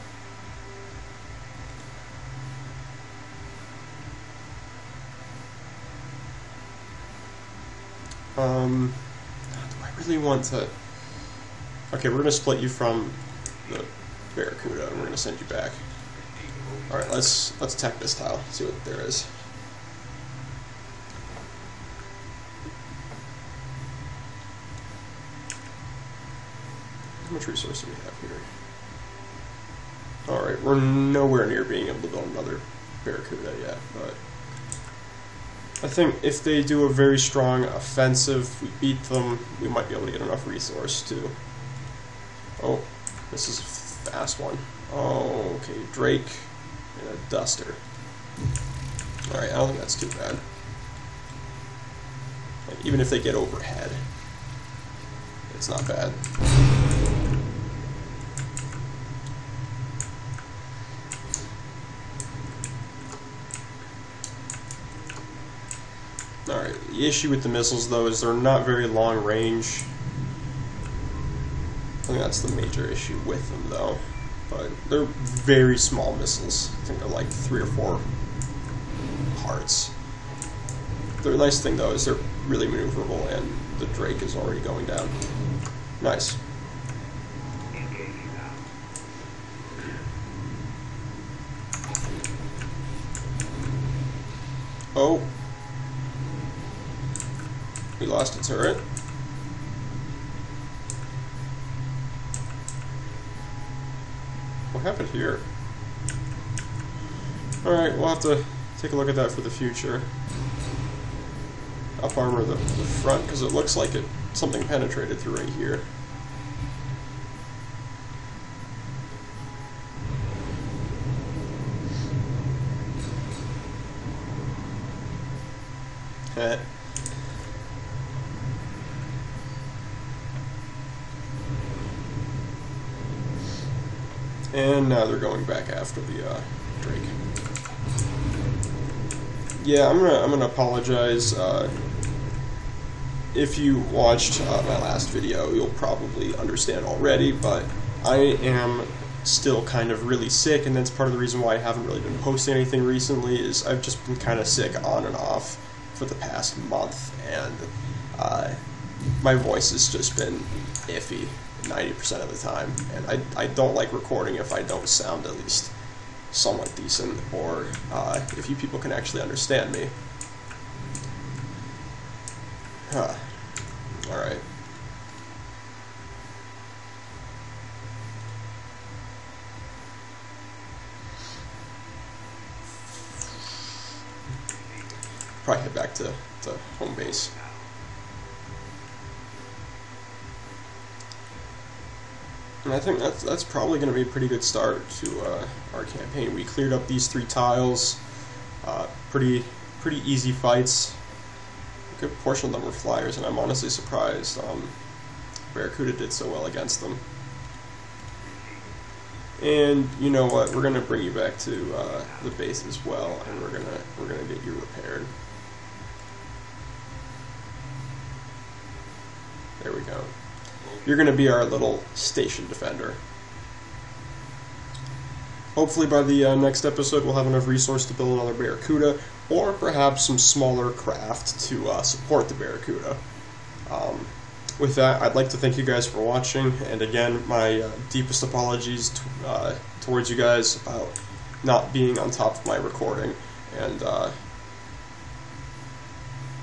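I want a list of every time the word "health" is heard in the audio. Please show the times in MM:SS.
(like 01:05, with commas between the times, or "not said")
not said.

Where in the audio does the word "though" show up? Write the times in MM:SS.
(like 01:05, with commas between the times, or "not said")
01:07, 01:13, 01:21.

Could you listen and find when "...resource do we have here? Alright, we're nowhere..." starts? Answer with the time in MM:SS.
00:27.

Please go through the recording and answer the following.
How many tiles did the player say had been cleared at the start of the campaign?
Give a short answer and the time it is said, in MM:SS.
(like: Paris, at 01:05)
3, at 03:17.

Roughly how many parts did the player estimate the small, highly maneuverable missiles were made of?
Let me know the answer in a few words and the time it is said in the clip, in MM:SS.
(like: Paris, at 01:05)
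3 or 4, at 01:17.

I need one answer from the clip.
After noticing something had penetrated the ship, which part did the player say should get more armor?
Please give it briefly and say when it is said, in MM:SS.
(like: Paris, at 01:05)
the front, at 01:52.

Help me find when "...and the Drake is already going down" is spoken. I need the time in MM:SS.
01:23.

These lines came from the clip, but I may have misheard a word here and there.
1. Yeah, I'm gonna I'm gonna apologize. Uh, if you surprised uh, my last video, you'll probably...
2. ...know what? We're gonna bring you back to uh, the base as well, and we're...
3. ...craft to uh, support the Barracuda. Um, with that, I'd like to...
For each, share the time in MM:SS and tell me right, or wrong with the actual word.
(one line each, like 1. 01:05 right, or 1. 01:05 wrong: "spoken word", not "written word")
1. 02:19 wrong: "watched", not "surprised"
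2. 03:30 right
3. 03:50 right.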